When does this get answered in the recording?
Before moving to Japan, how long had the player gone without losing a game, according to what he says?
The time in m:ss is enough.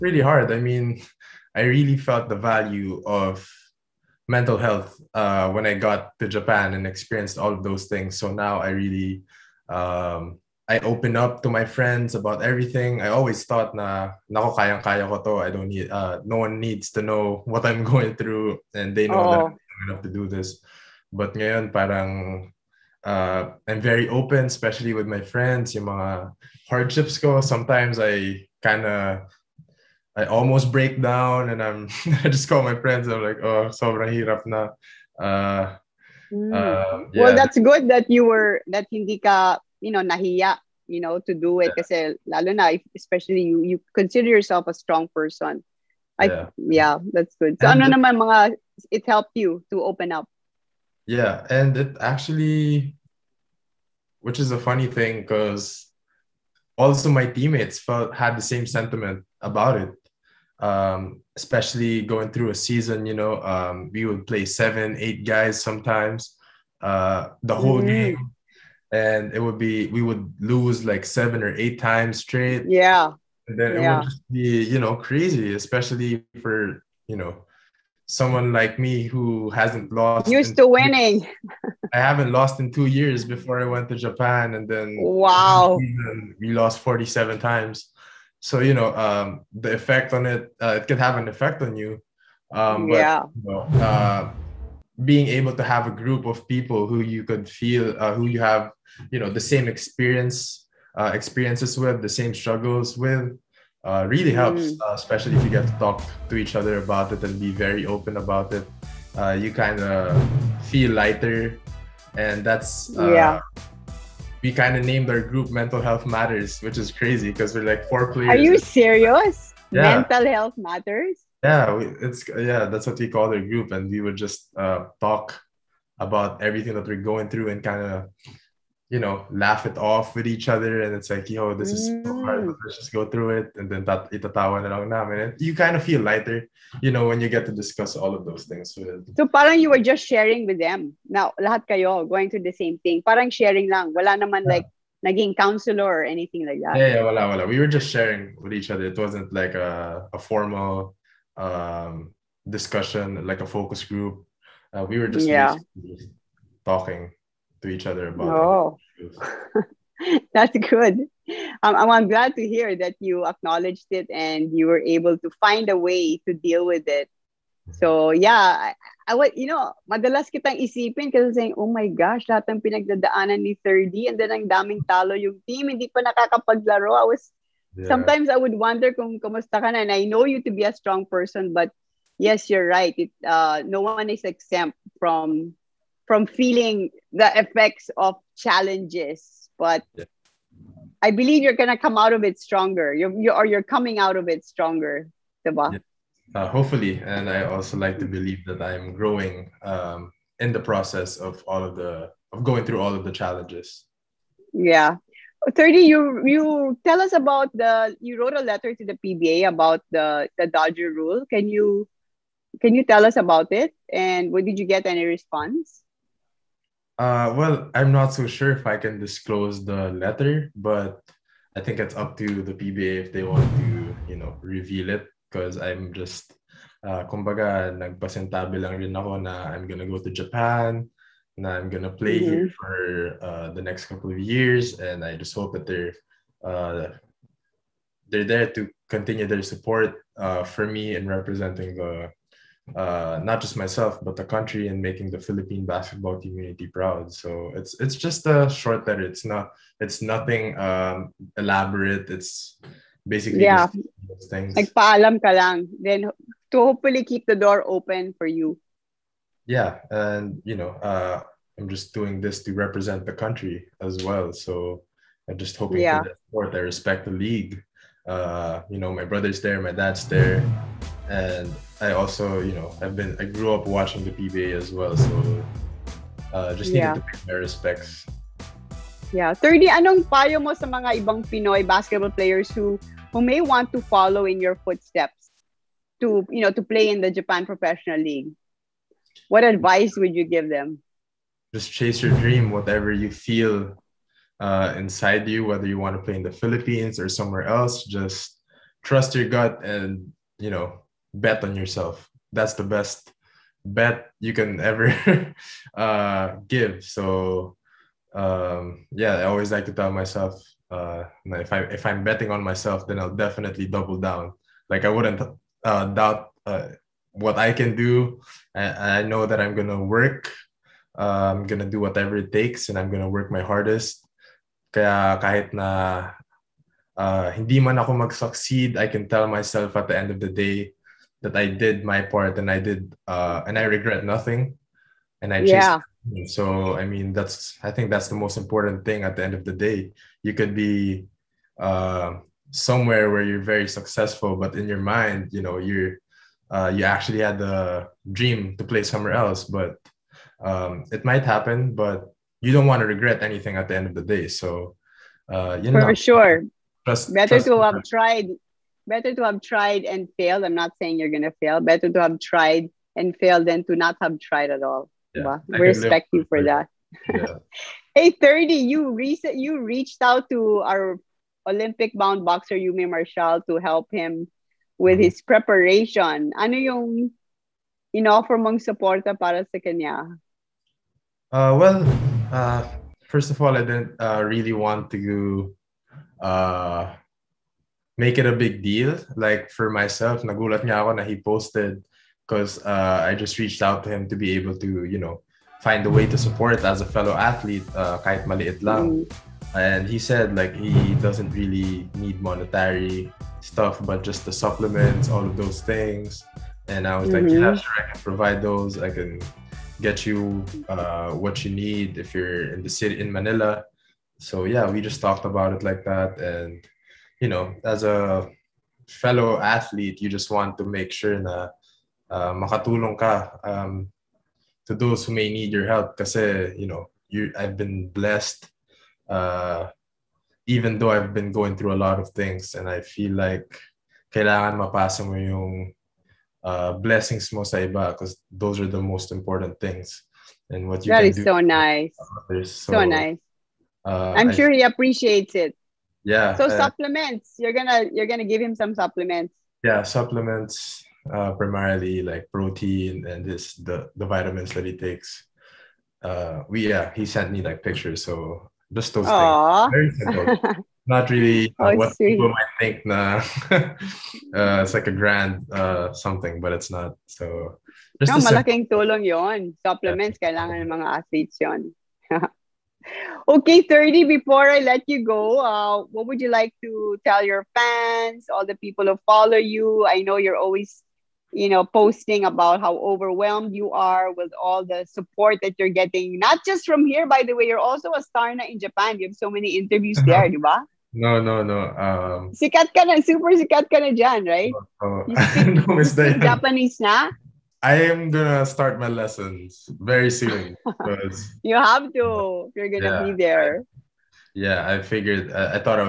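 1:22.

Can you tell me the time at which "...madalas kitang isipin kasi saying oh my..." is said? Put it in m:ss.
2:49.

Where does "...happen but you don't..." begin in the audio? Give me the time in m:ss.
5:51.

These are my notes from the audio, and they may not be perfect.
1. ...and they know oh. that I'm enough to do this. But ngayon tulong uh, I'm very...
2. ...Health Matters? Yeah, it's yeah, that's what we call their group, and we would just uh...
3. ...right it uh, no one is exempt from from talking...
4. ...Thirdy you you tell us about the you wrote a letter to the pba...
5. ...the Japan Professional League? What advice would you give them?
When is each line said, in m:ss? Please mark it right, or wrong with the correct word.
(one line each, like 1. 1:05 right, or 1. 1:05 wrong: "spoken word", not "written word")
1. 0:18 wrong: "parang", not "tulong"
2. 2:00 right
3. 3:02 wrong: "feeling", not "talking"
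4. 3:25 right
5. 4:46 right.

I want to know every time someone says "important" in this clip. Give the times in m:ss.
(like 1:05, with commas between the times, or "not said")
5:38, 7:19.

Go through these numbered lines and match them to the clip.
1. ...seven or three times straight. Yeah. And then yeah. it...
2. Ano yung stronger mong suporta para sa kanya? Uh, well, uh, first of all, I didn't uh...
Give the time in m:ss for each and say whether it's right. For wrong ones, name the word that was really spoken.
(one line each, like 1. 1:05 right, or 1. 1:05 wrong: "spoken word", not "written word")
1. 1:11 wrong: "eight", not "three"
2. 6:16 wrong: "offer", not "stronger".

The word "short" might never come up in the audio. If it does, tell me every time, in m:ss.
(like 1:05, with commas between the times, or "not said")
4:08.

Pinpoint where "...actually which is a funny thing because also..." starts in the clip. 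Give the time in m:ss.
0:51.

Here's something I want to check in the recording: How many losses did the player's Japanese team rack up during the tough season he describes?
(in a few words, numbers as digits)
47.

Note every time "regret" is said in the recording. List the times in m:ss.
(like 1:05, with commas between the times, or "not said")
5:33, 5:52.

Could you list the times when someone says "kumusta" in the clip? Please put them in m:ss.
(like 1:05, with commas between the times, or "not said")
2:59.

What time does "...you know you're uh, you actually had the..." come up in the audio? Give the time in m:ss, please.
5:45.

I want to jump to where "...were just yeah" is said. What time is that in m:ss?
2:34.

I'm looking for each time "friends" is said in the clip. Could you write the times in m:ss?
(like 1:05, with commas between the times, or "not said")
0:11, 0:25, 0:32.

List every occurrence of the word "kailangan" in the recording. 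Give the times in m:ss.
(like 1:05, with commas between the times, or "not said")
7:14, 7:50.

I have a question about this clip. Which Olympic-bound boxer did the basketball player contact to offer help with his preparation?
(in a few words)
Eumir Marcial.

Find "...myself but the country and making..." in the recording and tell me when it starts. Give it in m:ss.
4:03.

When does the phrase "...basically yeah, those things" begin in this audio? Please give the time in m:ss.
4:13.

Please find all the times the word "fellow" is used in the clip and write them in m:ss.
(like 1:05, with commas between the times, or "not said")
6:36, 6:58.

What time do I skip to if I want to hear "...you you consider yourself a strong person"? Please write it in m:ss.
0:43.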